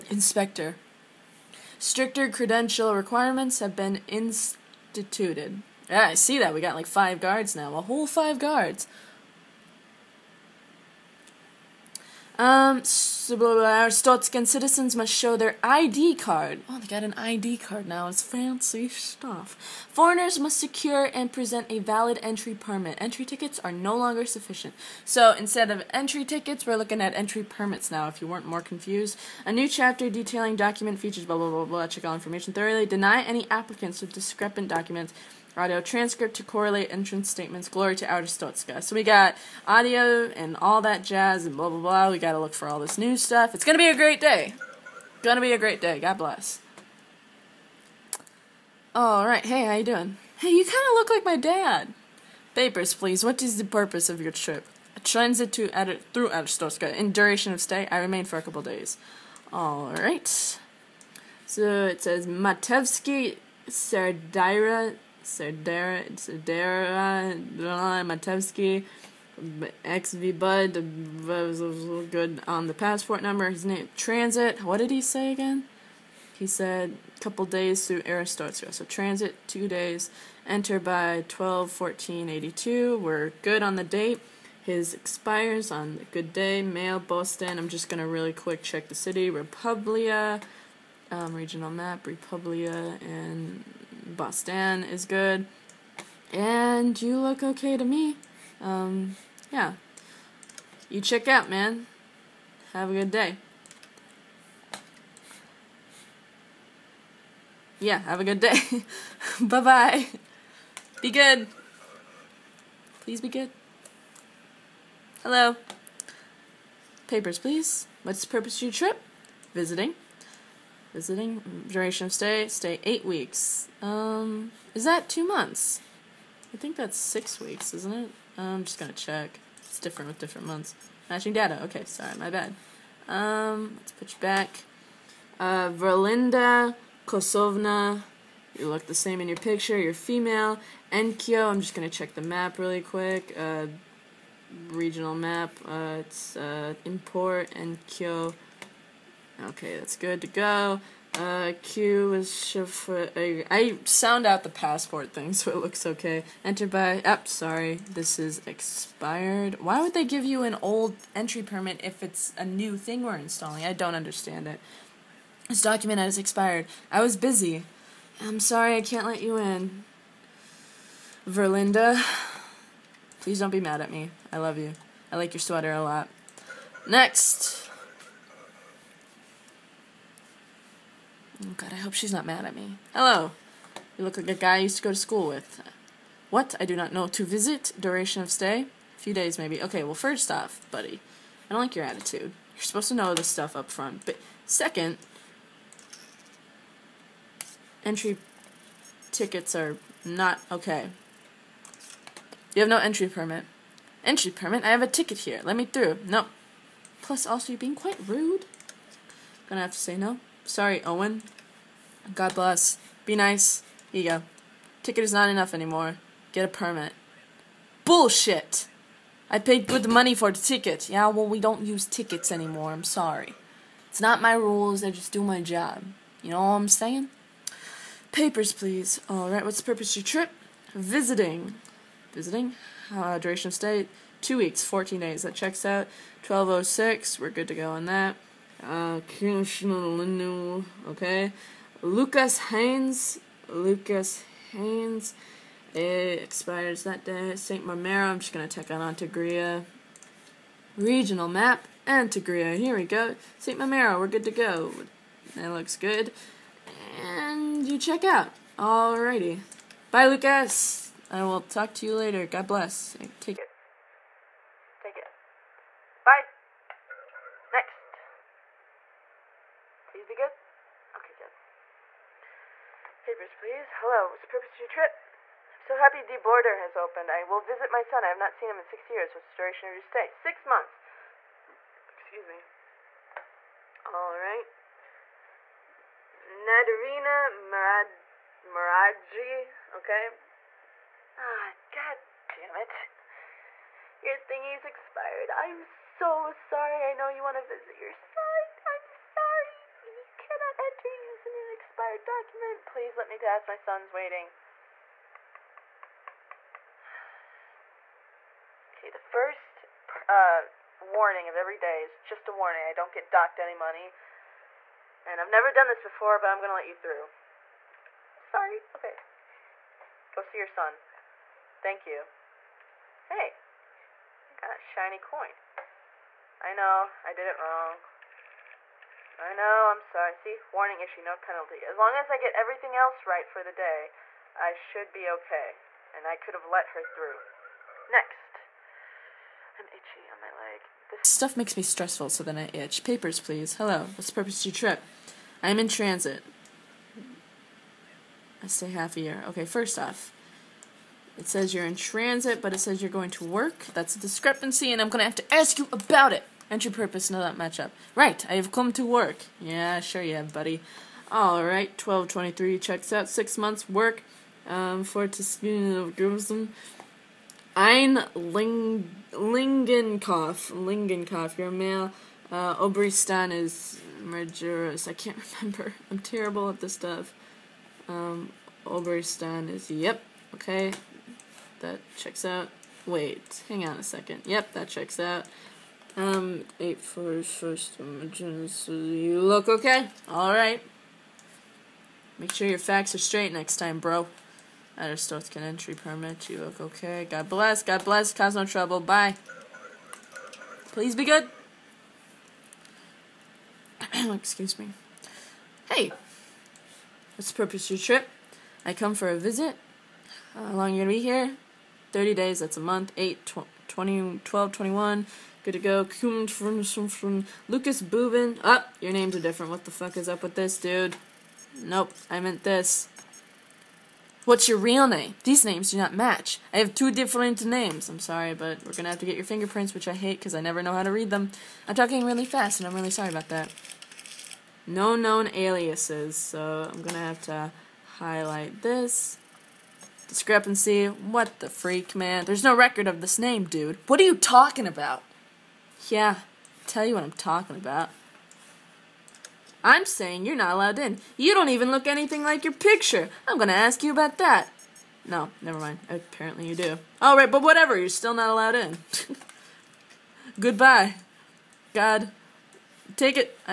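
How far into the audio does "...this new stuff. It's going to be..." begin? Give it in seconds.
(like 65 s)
42 s.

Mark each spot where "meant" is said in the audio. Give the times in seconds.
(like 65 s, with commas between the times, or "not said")
422 s.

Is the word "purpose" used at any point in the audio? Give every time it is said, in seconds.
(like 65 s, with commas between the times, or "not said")
53 s, 118 s, 229 s, 274 s, 344 s, 356 s, 407 s.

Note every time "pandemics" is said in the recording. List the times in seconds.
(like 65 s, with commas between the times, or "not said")
not said.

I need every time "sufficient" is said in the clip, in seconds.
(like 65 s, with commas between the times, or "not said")
24 s.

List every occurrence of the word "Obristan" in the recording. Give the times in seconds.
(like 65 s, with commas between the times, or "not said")
372 s, 378 s.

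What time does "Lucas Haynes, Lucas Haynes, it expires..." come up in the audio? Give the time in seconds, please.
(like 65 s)
241 s.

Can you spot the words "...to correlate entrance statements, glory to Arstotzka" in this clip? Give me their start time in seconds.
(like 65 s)
36 s.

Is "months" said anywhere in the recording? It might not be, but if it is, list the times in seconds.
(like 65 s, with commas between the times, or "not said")
125 s, 130 s, 280 s, 363 s, 412 s.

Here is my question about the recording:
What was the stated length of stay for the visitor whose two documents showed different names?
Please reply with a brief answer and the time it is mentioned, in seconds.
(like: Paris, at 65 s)
30 days, at 411 s.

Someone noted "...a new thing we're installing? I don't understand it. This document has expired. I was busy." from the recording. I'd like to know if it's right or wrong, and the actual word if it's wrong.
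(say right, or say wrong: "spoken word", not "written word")
right.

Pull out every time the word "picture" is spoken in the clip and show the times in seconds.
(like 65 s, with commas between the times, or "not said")
139 s, 452 s.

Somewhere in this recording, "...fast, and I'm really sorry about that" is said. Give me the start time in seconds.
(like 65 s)
432 s.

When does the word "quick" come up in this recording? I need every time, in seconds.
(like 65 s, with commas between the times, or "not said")
88 s, 142 s.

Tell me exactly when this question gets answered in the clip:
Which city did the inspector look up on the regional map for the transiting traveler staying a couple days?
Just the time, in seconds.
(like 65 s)
86 s.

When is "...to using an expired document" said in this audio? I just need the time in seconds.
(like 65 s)
300 s.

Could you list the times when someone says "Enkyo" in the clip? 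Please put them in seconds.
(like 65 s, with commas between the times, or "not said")
140 s, 147 s.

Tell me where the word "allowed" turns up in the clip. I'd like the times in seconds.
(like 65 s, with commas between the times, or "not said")
450 s, 458 s.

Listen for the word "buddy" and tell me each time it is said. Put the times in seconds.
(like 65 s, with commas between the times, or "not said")
190 s, 360 s.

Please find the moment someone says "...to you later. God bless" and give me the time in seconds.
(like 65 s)
261 s.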